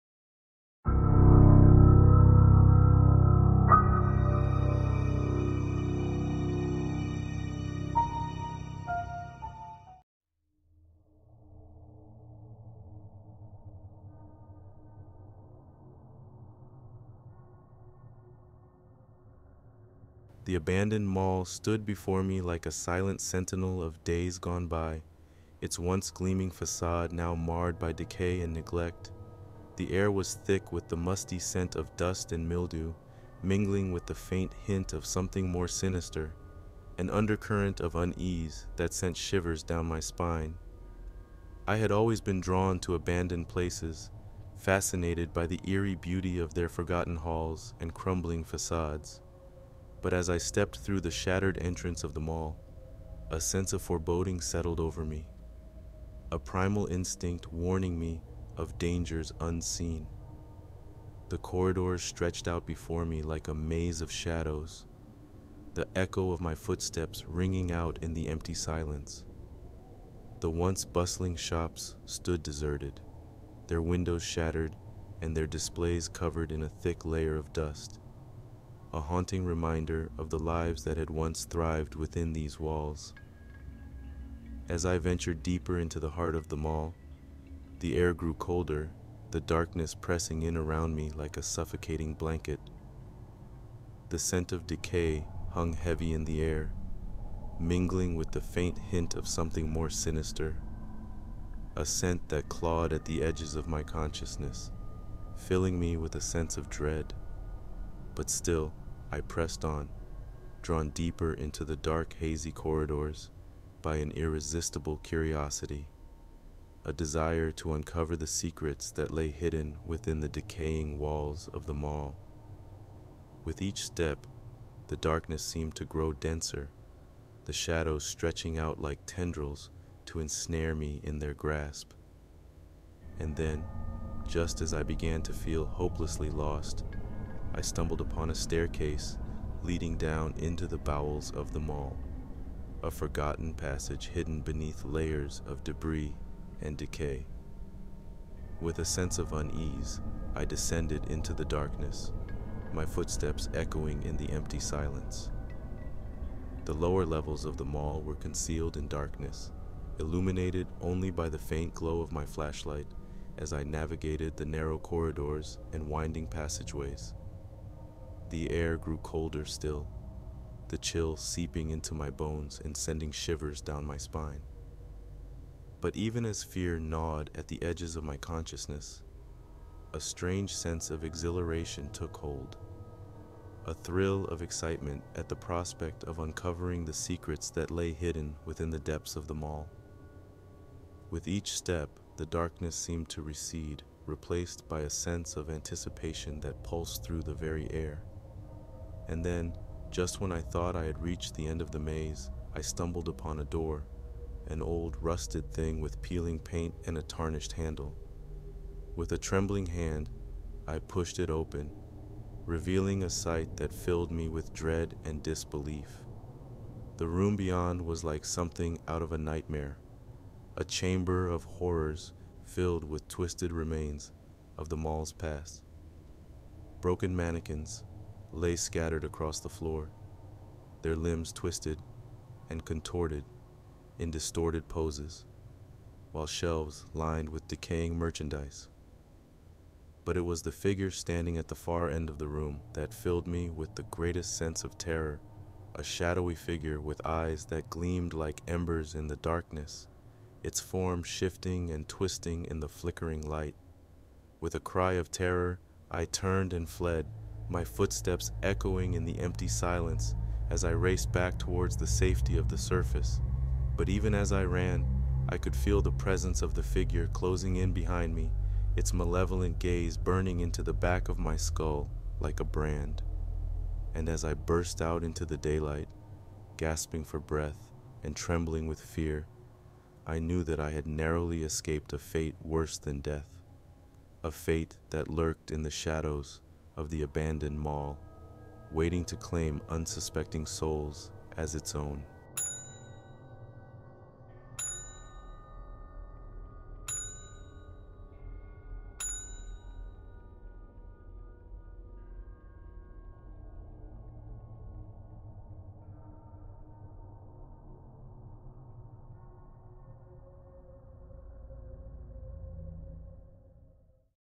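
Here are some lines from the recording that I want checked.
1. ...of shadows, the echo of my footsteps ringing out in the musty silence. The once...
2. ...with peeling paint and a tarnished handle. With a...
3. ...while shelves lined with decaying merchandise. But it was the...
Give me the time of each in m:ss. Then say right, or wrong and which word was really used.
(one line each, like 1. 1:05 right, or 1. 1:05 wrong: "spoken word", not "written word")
1. 1:04 wrong: "empty", not "musty"
2. 3:25 right
3. 3:56 right.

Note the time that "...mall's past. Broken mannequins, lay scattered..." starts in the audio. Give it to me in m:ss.
3:44.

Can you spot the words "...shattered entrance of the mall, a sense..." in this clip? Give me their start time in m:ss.
0:51.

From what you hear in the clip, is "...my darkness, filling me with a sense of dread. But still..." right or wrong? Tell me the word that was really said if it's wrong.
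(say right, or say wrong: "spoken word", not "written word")
wrong: "consciousness", not "darkness".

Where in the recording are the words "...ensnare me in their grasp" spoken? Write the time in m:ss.
2:10.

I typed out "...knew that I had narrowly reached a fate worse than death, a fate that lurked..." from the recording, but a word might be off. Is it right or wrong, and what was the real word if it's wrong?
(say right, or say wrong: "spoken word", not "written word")
wrong: "escaped", not "reached".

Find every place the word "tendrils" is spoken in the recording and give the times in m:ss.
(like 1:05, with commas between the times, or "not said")
2:09.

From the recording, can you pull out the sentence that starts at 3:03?
A thrill of excitement at the prospect of uncovering the secrets that lay hidden within the depths of the mall.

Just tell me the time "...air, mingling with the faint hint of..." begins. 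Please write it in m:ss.
1:36.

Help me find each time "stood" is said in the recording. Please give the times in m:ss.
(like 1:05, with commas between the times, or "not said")
0:21, 1:12.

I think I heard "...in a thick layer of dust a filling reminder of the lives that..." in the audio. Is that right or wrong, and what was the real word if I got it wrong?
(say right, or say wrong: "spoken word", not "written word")
wrong: "haunting", not "filling".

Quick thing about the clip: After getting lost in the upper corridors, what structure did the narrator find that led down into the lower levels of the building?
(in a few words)
a staircase.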